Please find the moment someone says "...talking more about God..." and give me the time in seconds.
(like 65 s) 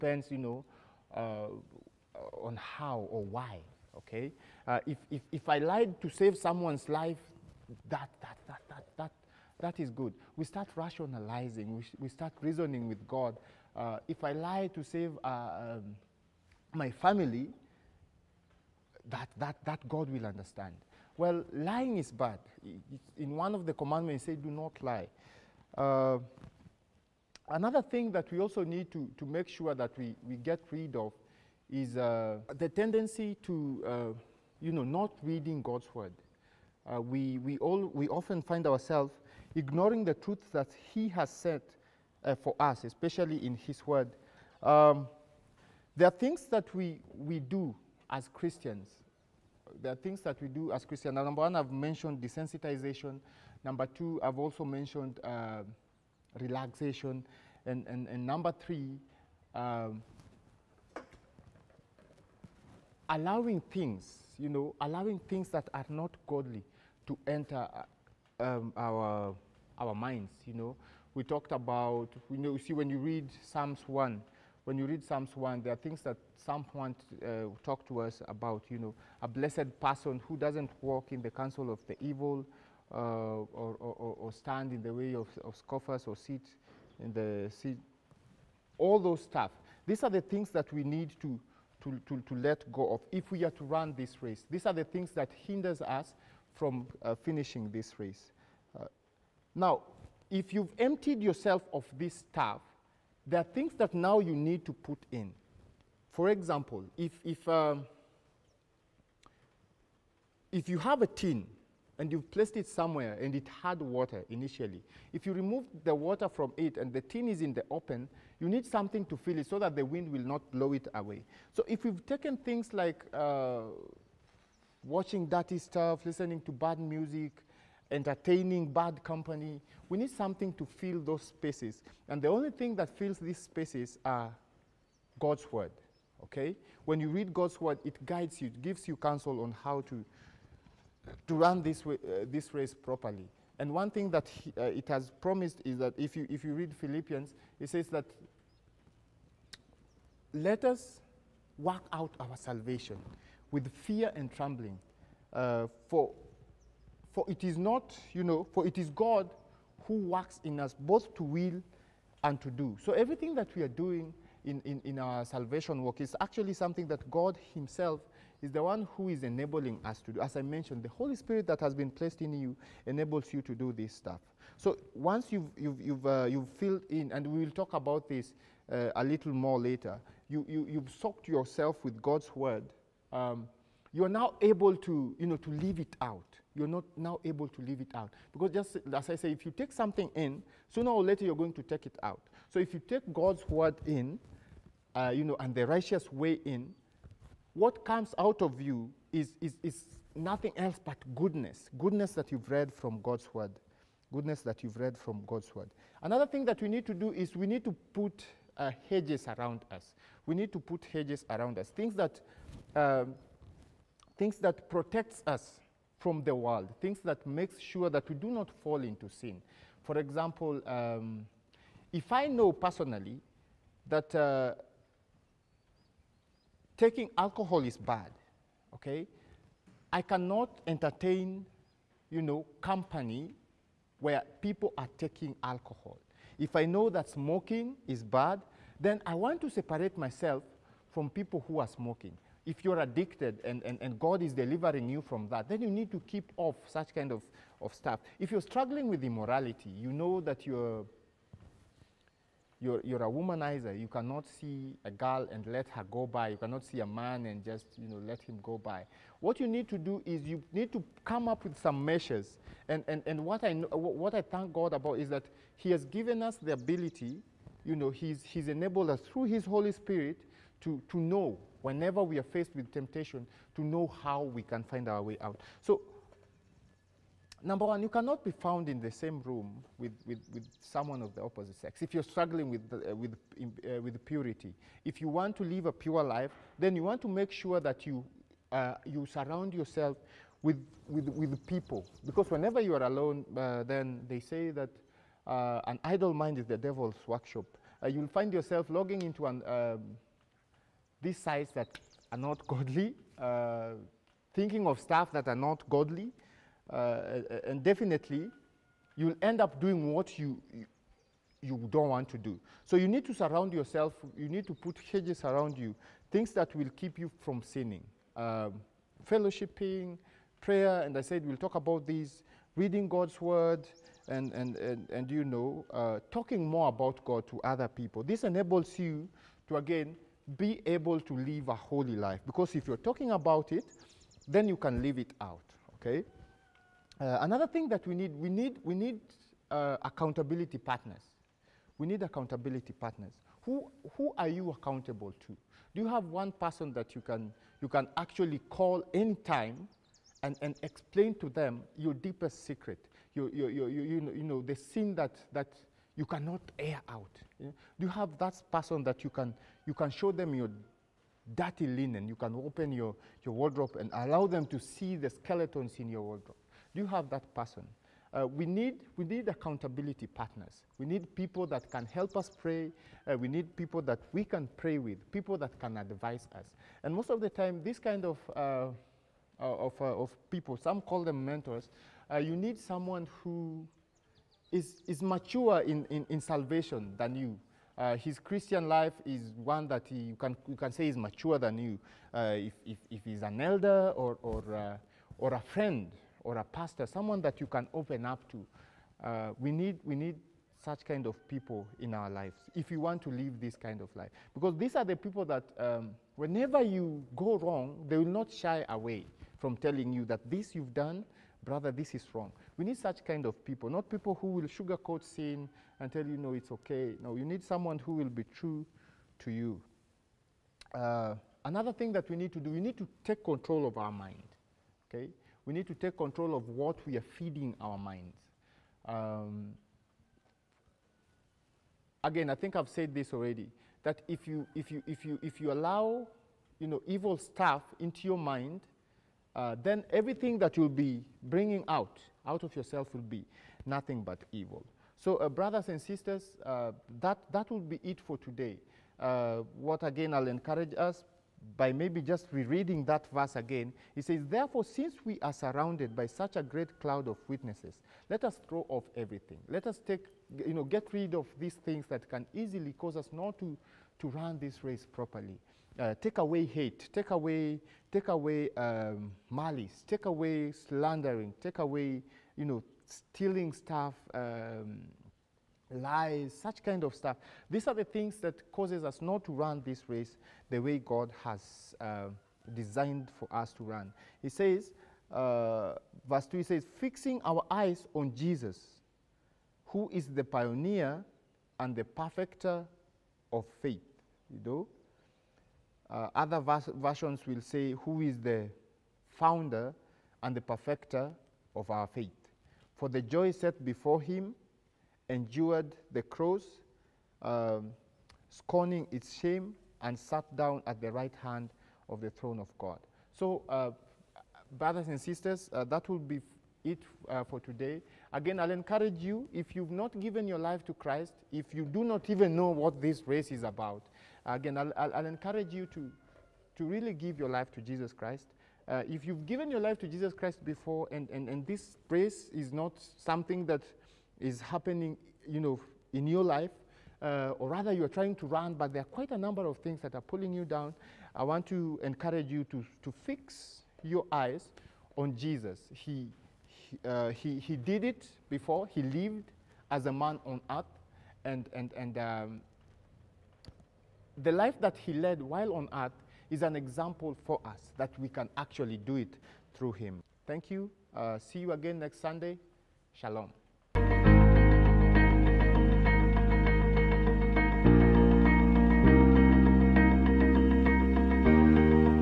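326 s.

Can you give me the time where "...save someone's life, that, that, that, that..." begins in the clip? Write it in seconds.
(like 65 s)
6 s.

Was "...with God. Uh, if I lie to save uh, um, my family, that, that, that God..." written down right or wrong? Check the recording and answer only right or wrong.
right.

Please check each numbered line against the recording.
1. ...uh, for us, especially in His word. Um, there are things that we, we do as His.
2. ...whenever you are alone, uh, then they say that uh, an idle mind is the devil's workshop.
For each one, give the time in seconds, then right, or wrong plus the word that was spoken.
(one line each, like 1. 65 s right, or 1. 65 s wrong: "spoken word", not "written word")
1. 42 s wrong: "Christians", not "His"
2. 292 s right.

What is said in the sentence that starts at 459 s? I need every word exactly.
Let us take, you know, get rid of these things that can easily cause us not to, to run this race properly.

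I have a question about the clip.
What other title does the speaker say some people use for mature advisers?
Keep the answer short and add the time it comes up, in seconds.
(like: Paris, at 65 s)
Mentors, at 381 s.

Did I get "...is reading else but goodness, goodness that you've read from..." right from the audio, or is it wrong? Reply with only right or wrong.
wrong.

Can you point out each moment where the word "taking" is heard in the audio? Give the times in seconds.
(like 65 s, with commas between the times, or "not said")
226 s, 234 s.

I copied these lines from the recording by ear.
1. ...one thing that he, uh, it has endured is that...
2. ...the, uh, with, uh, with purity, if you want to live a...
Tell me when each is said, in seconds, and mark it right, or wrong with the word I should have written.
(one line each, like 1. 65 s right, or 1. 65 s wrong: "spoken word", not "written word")
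1. 143 s wrong: "promised", not "endured"
2. 282 s right.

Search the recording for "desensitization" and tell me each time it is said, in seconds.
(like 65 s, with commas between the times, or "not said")
52 s.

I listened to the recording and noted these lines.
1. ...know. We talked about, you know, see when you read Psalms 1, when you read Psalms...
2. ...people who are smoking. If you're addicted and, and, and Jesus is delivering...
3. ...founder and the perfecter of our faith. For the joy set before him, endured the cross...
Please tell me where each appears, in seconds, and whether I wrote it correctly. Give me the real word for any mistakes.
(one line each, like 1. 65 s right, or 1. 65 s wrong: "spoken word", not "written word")
1. 70 s right
2. 241 s wrong: "God", not "Jesus"
3. 499 s right.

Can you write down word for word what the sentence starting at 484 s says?
He says, uh, verse 2, he says, fixing our eyes on Jesus, who is the pioneer and the perfecter of faith.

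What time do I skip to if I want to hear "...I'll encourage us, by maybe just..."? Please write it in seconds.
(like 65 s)
450 s.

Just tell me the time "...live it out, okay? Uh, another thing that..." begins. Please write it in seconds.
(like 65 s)
334 s.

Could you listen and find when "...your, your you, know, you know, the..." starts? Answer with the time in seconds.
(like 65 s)
353 s.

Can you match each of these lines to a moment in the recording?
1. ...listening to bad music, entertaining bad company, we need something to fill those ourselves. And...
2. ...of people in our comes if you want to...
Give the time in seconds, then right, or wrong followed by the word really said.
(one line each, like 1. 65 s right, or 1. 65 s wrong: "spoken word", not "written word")
1. 126 s wrong: "spaces", not "ourselves"
2. 401 s wrong: "lives", not "comes".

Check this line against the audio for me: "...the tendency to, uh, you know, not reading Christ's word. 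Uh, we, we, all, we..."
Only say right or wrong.
wrong.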